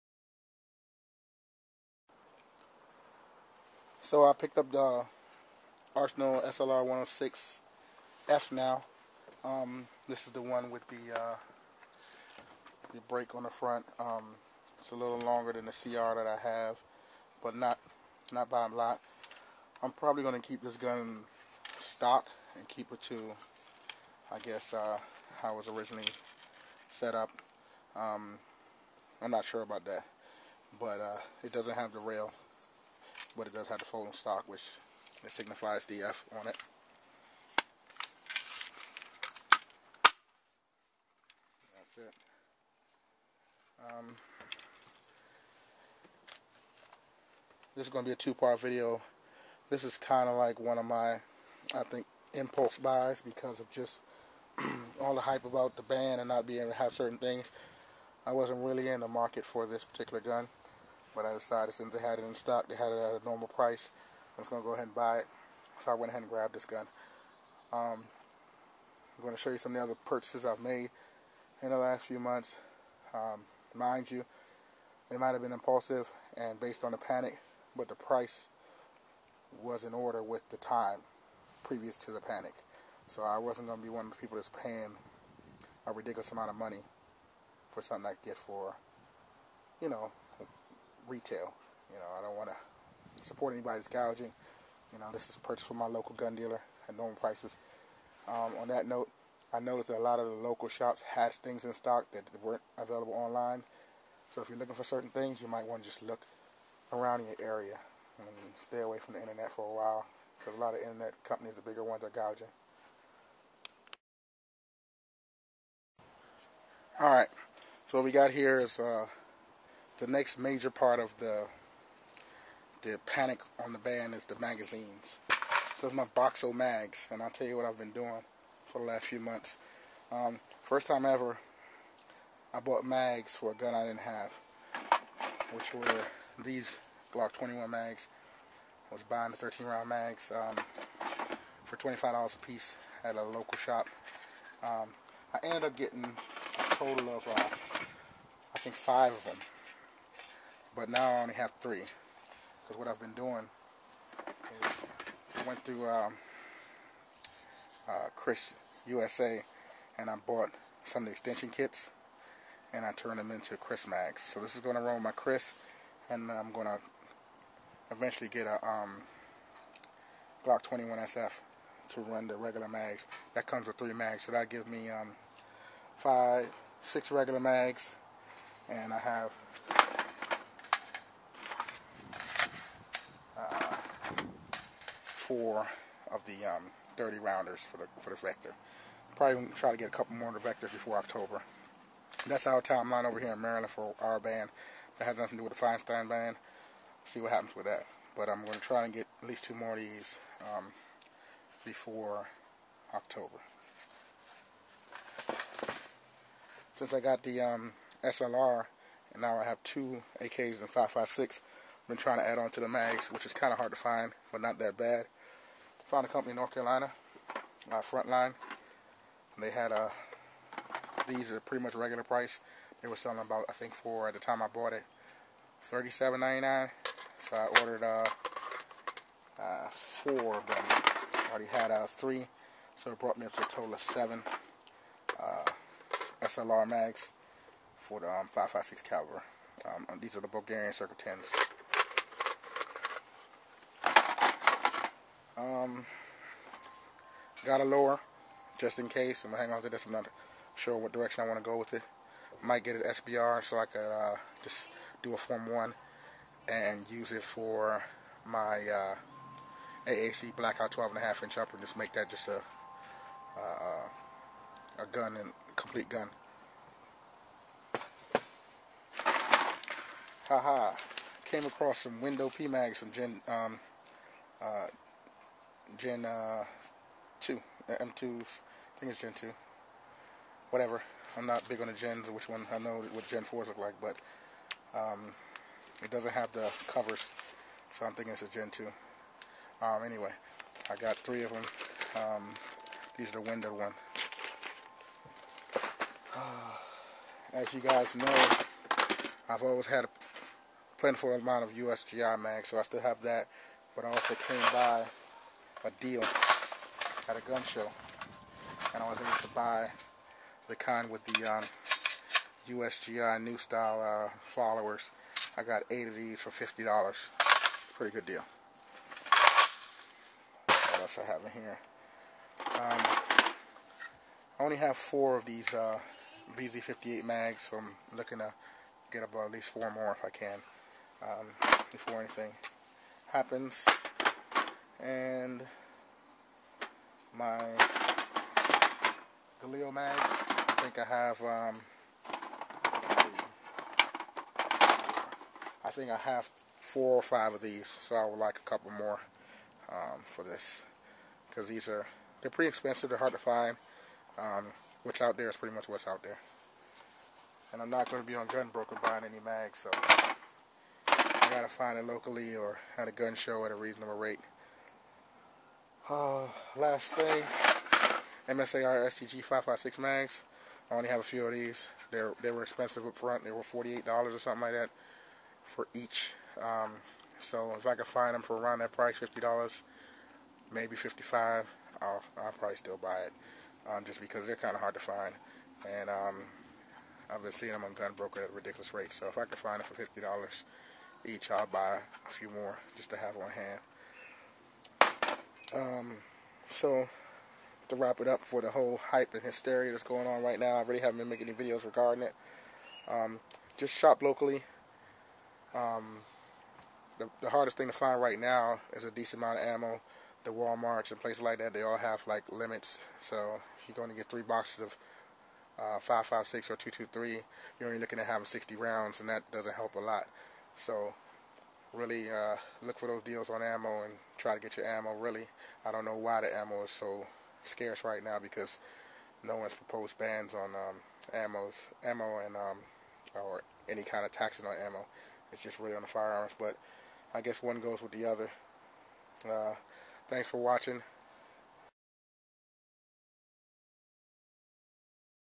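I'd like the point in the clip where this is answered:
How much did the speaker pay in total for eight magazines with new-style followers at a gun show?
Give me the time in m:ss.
5:16.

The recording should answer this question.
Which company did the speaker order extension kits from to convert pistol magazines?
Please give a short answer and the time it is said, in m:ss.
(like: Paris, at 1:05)
KRISS USA, at 2:38.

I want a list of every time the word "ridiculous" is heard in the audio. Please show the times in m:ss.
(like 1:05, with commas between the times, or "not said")
1:25, 6:28.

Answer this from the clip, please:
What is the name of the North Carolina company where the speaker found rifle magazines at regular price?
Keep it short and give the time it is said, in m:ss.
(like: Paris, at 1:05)
Frontline, at 3:37.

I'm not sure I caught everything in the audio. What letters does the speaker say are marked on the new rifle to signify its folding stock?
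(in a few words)
DF.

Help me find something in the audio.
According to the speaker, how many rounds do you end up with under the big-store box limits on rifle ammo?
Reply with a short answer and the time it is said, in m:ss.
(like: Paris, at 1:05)
60, at 6:58.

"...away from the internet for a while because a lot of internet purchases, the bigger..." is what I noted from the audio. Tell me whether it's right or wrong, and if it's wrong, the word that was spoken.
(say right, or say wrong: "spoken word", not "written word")
wrong: "companies", not "purchases".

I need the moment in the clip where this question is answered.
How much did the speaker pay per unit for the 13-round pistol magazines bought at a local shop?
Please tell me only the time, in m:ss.
2:21.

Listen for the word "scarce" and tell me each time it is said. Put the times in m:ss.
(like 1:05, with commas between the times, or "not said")
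7:07.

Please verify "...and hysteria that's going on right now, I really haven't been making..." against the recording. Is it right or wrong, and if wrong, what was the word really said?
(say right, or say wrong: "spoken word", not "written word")
right.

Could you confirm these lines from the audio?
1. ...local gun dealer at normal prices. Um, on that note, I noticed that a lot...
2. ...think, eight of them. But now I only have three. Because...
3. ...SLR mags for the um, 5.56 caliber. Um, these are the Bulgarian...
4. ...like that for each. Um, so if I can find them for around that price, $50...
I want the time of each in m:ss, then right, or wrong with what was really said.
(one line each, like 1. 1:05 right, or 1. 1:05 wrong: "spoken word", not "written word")
1. 1:35 right
2. 2:28 wrong: "five", not "eight"
3. 3:56 right
4. 6:14 right.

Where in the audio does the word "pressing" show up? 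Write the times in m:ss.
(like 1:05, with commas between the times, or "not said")
not said.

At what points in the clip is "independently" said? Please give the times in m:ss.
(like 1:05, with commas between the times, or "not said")
not said.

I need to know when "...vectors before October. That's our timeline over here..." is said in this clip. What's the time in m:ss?
3:10.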